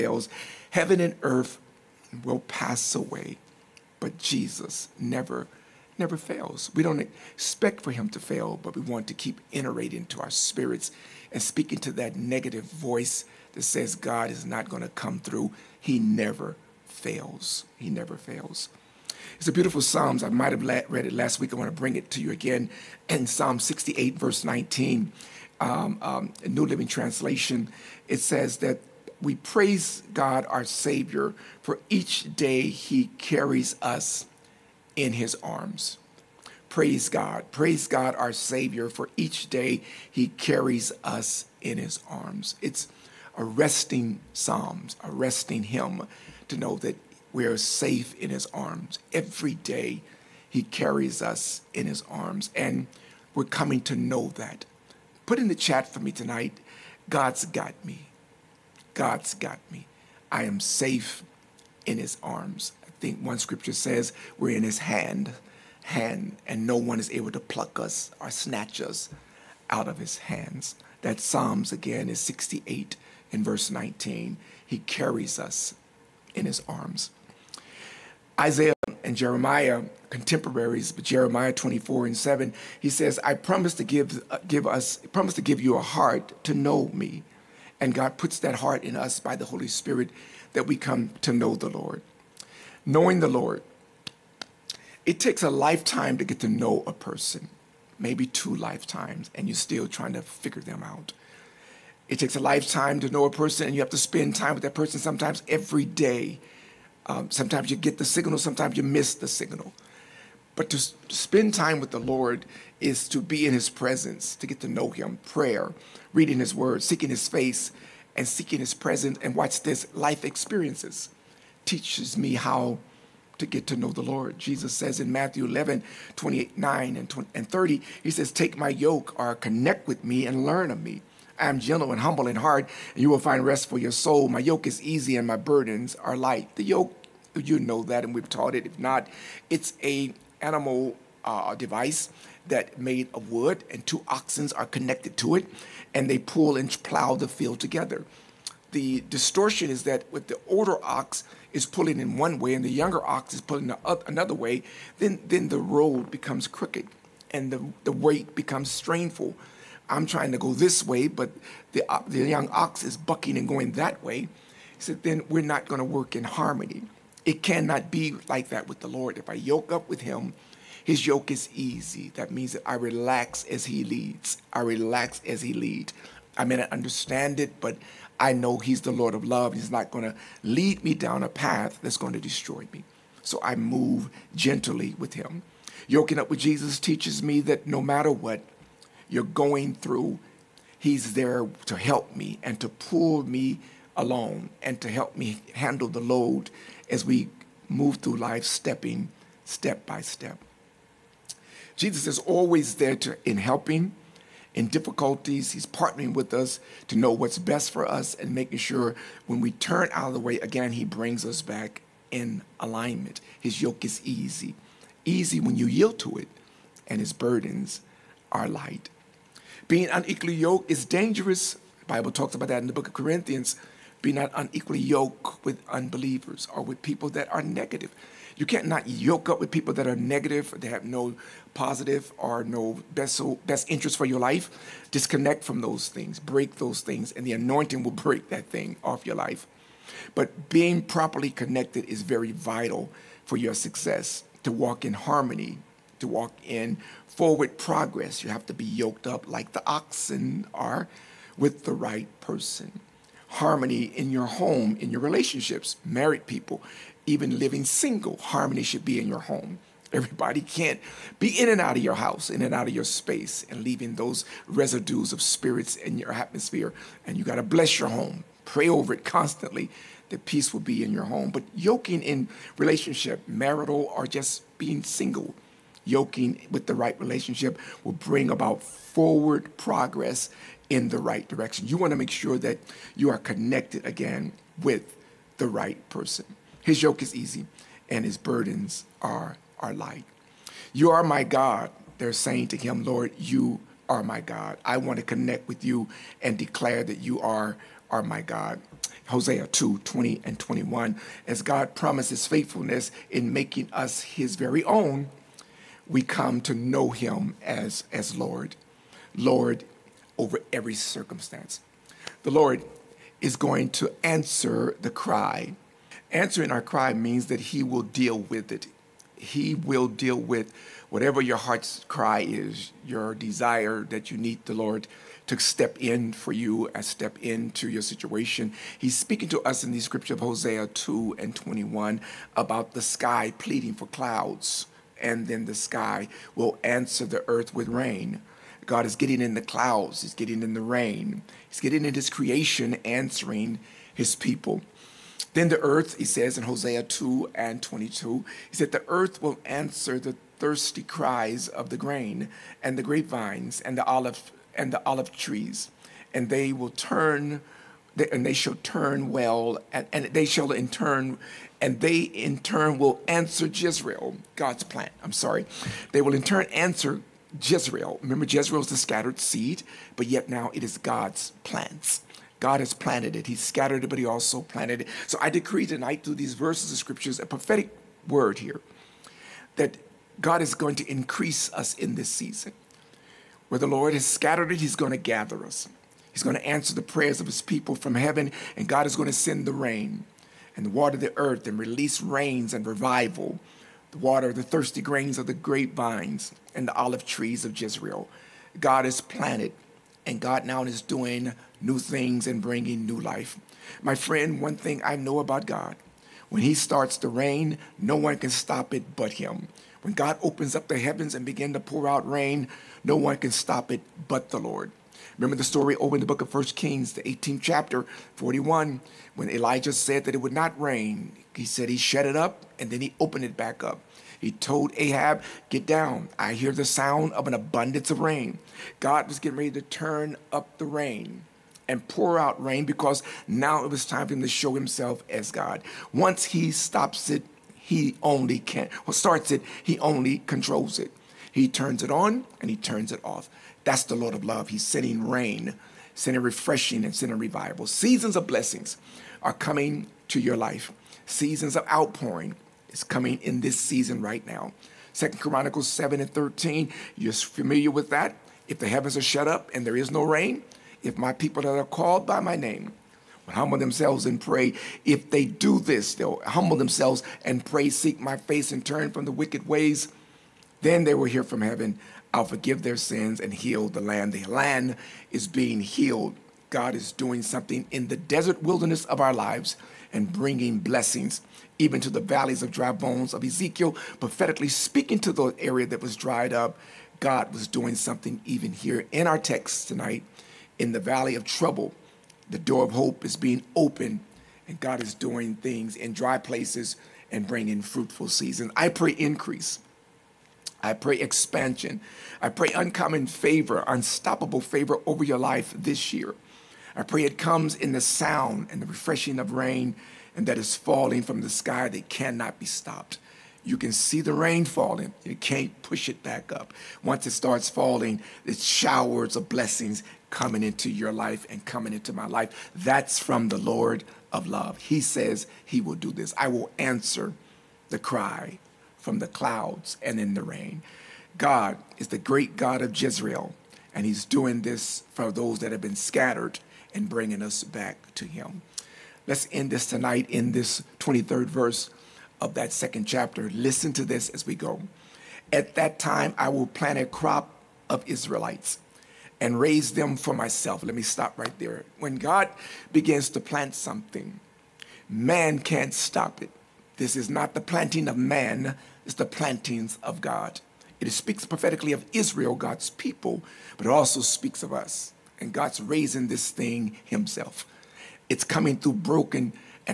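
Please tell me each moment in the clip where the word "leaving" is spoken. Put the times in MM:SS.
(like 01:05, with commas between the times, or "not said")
04:23.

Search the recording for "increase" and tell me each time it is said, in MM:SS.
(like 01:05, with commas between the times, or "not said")
06:20, 08:18.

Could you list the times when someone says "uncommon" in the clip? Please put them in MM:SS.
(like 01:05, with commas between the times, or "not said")
08:22.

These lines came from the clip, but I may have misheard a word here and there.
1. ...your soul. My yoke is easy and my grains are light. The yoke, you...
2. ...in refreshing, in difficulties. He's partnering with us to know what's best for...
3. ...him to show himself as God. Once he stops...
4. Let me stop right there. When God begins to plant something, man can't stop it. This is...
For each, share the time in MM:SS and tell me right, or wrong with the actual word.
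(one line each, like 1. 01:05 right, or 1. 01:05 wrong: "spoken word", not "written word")
1. 02:13 wrong: "burdens", not "grains"
2. 03:23 wrong: "helping", not "refreshing"
3. 07:14 right
4. 09:10 right.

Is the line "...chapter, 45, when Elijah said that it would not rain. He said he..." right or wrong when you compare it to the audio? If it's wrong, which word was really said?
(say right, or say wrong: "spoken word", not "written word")
wrong: "41", not "45".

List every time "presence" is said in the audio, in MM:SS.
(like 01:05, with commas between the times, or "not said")
01:53, 01:58.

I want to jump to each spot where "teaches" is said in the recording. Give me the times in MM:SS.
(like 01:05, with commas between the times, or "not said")
02:01, 03:06.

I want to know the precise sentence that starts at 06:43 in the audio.
My friend, one thing I know about God when He starts to rain, no one can stop it but Him.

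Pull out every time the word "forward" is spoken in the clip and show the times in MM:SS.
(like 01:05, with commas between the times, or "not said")
04:07, 04:38.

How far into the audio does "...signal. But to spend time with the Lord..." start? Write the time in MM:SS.
01:49.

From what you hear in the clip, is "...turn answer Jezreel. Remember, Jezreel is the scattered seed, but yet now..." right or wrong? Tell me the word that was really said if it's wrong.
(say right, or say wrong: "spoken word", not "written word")
right.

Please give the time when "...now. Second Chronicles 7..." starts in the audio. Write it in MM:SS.
07:34.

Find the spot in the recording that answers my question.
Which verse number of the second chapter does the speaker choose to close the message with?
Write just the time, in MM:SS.
09:00.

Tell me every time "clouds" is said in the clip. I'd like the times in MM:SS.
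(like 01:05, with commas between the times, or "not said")
05:33, 05:39, 08:49.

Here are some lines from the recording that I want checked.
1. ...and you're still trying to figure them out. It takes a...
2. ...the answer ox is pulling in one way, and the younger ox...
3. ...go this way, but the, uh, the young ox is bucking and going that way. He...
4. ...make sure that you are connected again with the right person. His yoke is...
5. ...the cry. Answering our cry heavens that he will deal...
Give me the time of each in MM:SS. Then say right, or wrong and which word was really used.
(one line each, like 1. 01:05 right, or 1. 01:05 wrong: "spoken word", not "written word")
1. 01:39 right
2. 02:30 wrong: "older", not "answer"
3. 02:40 right
4. 04:41 right
5. 05:14 wrong: "means", not "heavens".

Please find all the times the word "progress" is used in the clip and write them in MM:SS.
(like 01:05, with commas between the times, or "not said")
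04:07, 04:39.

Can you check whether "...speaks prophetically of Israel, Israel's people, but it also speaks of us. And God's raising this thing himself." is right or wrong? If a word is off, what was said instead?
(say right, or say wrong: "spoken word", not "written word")
wrong: "God", not "Israel".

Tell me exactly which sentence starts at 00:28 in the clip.
It says that we praise God, our Savior, for each day He carries us in His arms.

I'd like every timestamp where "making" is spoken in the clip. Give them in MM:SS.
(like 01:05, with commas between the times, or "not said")
03:28, 05:03.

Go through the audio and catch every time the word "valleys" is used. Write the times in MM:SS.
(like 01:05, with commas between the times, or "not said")
08:01, 08:10.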